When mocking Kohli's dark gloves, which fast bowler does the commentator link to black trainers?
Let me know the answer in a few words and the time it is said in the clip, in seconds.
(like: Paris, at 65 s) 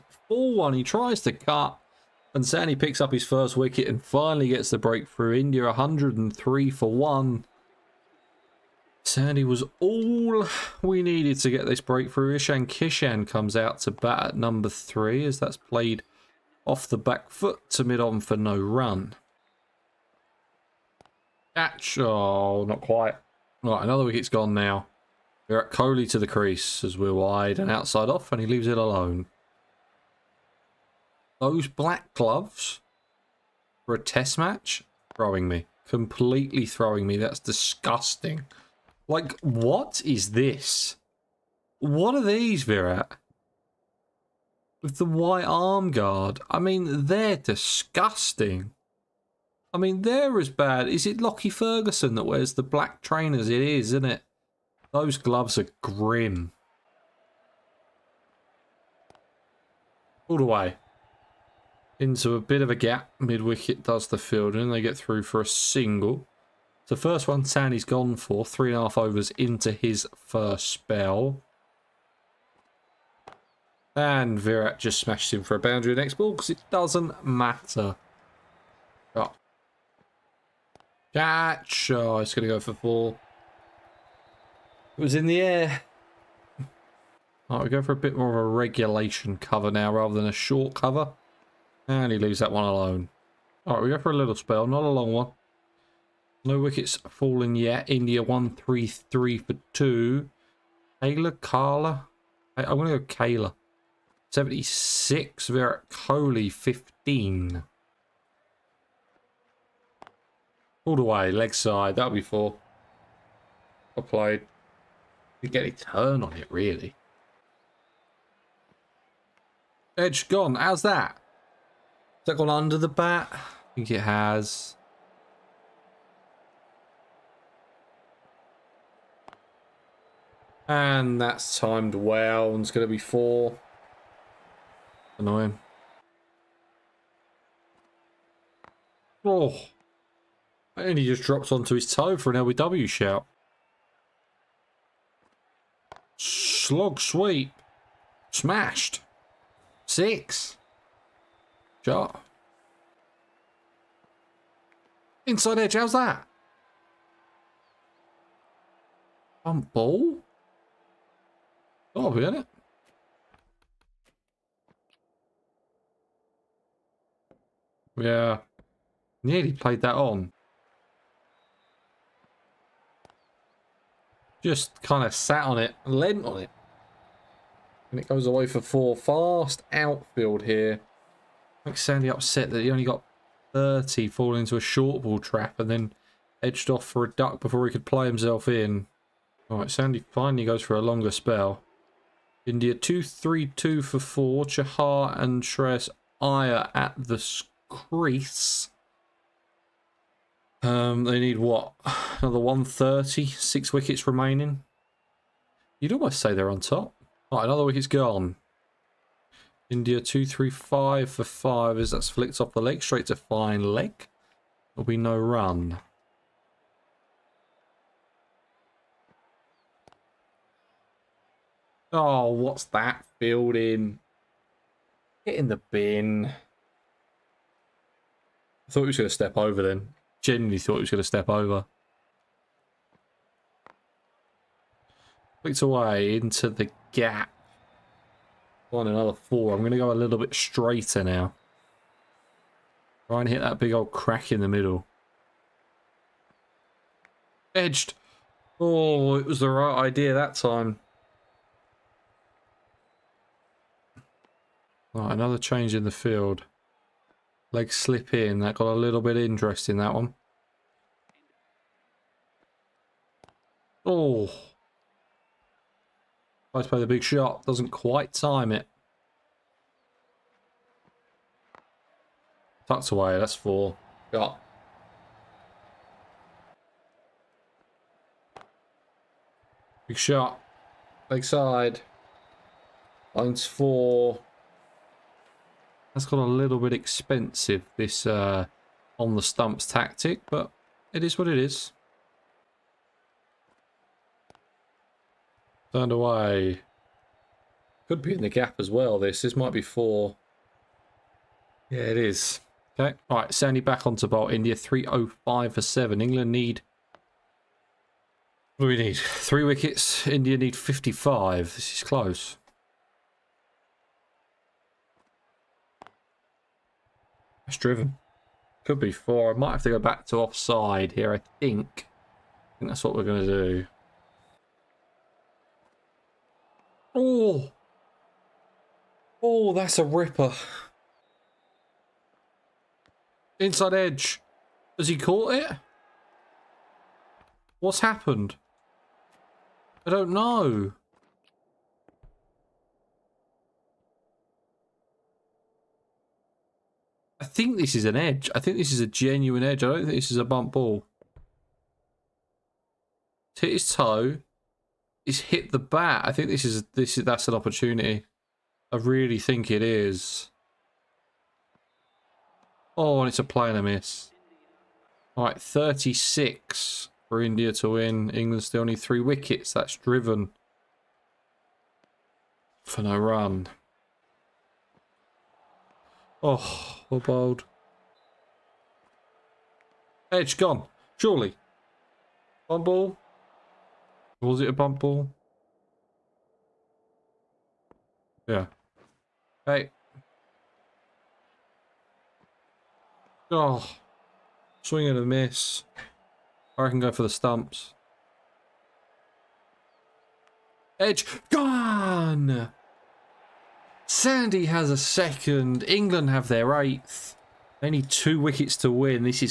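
Lockie Ferguson, at 51 s.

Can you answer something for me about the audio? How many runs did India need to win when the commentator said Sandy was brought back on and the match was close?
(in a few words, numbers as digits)
55.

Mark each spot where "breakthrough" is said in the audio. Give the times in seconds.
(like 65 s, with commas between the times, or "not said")
4 s, 11 s.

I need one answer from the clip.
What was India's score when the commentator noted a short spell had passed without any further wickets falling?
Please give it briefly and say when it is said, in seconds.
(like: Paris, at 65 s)
133 for 2, at 98 s.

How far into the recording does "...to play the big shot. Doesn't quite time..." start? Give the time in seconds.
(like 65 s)
266 s.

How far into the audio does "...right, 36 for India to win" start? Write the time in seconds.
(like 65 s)
365 s.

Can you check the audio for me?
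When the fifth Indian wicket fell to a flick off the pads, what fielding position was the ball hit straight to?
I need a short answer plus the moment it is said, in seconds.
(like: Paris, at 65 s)
fine leg, at 213 s.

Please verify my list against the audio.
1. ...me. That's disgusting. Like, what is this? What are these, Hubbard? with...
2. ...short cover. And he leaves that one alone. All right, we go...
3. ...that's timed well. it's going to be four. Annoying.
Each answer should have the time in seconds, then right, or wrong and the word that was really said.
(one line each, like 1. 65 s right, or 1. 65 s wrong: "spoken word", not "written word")
1. 37 s wrong: "Virat", not "Hubbard"
2. 90 s right
3. 131 s right.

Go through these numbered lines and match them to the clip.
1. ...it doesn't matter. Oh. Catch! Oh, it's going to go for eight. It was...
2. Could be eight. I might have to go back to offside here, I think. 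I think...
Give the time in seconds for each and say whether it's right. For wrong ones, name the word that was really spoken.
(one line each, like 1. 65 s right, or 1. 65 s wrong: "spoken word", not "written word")
1. 76 s wrong: "four", not "eight"
2. 318 s wrong: "four", not "eight".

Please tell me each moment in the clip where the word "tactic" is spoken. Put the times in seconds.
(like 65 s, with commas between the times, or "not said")
289 s.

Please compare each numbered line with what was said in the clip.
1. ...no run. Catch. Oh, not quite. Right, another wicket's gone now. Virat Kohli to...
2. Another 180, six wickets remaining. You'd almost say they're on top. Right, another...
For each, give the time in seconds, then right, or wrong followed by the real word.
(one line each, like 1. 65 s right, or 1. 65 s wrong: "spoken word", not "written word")
1. 18 s right
2. 202 s wrong: "130", not "180".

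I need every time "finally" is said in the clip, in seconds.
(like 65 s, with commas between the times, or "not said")
4 s, 190 s.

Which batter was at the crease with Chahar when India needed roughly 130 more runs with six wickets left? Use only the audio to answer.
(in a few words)
Shreyas Iyer.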